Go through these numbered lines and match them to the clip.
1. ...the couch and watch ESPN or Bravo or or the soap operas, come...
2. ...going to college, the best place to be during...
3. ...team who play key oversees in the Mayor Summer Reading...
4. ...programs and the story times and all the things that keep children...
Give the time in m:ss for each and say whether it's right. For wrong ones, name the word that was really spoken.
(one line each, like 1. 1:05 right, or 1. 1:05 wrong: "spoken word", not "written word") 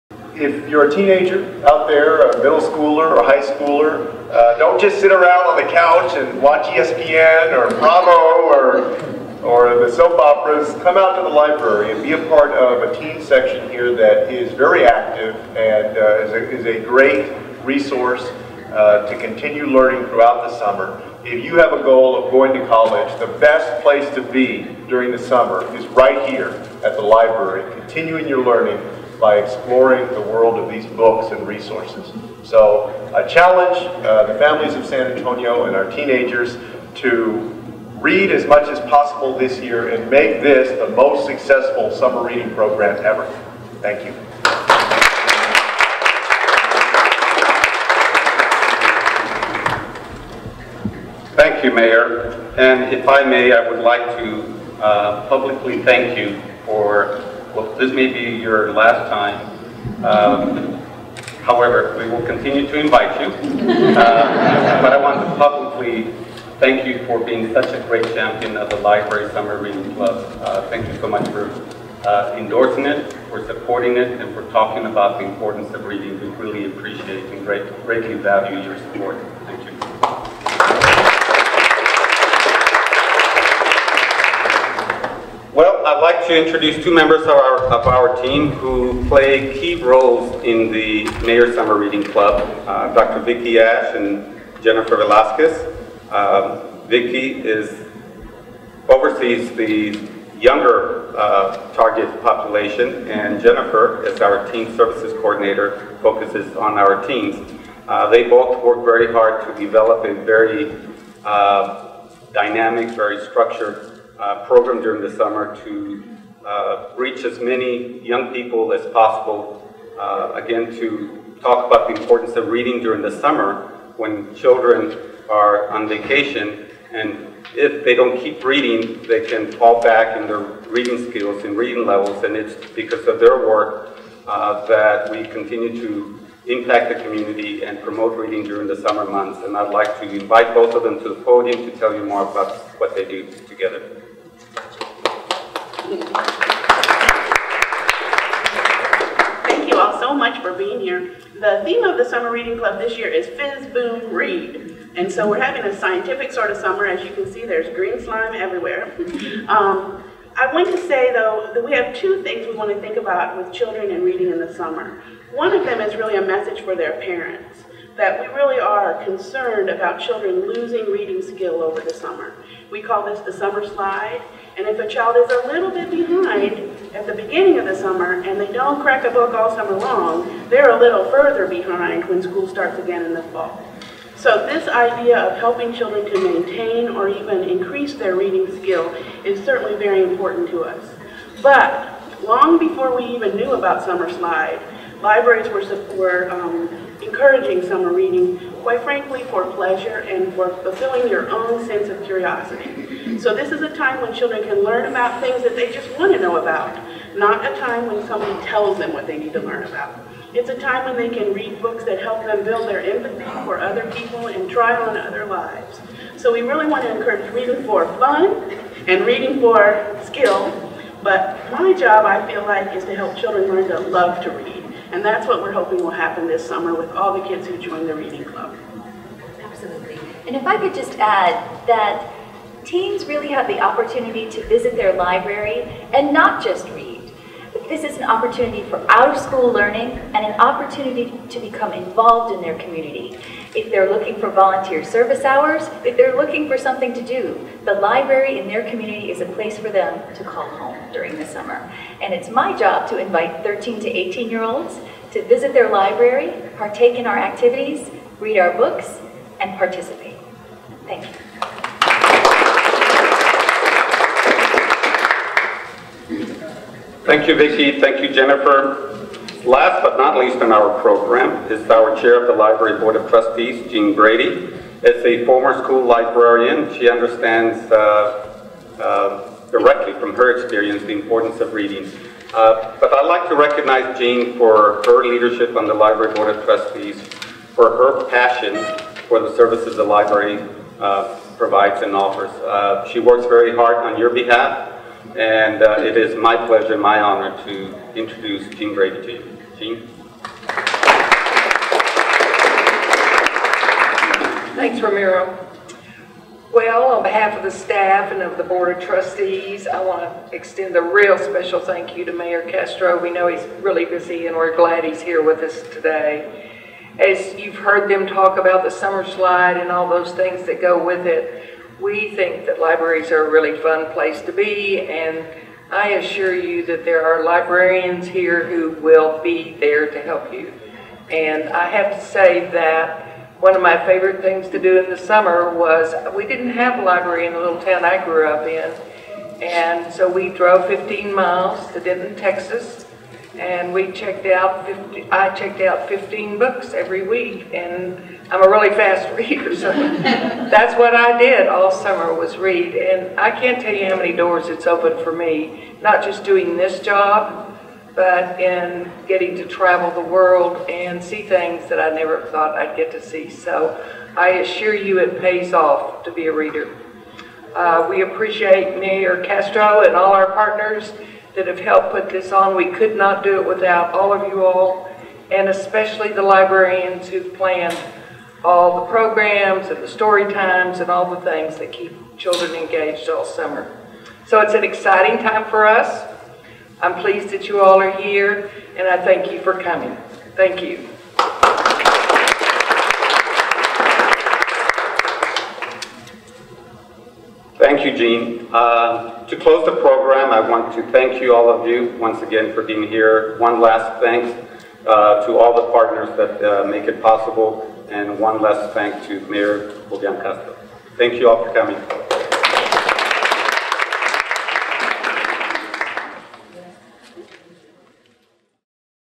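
1. 0:05 right
2. 0:22 right
3. 1:28 wrong: "roles", not "oversees"
4. 6:18 right.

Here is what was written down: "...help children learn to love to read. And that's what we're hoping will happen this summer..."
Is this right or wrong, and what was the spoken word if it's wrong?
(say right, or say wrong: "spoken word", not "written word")
right.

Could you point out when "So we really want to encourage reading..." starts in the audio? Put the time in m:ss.
3:36.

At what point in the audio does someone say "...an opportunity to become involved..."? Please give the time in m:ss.
4:00.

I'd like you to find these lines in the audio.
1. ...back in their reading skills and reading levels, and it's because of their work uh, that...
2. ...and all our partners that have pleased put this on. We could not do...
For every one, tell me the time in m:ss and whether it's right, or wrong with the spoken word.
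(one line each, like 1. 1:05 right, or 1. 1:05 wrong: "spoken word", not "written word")
1. 2:09 right
2. 6:09 wrong: "helped", not "pleased".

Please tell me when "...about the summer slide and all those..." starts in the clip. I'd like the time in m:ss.
5:18.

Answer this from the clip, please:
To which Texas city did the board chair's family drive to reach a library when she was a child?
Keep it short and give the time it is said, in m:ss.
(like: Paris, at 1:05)
Denton, at 5:41.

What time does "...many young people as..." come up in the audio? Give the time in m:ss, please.
1:57.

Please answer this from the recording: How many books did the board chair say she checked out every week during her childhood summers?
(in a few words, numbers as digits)
15.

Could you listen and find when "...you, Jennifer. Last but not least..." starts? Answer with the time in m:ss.
4:28.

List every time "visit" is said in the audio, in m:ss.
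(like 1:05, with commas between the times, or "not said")
3:54, 4:15.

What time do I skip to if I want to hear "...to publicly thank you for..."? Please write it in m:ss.
1:05.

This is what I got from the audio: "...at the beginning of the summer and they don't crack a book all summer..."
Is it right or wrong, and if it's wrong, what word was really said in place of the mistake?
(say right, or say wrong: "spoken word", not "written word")
right.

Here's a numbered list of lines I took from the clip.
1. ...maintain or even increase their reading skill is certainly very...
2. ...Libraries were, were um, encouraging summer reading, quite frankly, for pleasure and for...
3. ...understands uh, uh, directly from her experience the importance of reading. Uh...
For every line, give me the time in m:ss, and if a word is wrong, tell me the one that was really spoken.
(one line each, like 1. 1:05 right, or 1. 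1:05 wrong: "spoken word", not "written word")
1. 3:06 right
2. 3:15 right
3. 4:36 right.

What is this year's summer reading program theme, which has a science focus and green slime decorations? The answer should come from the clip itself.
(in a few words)
Fizz Boom Read.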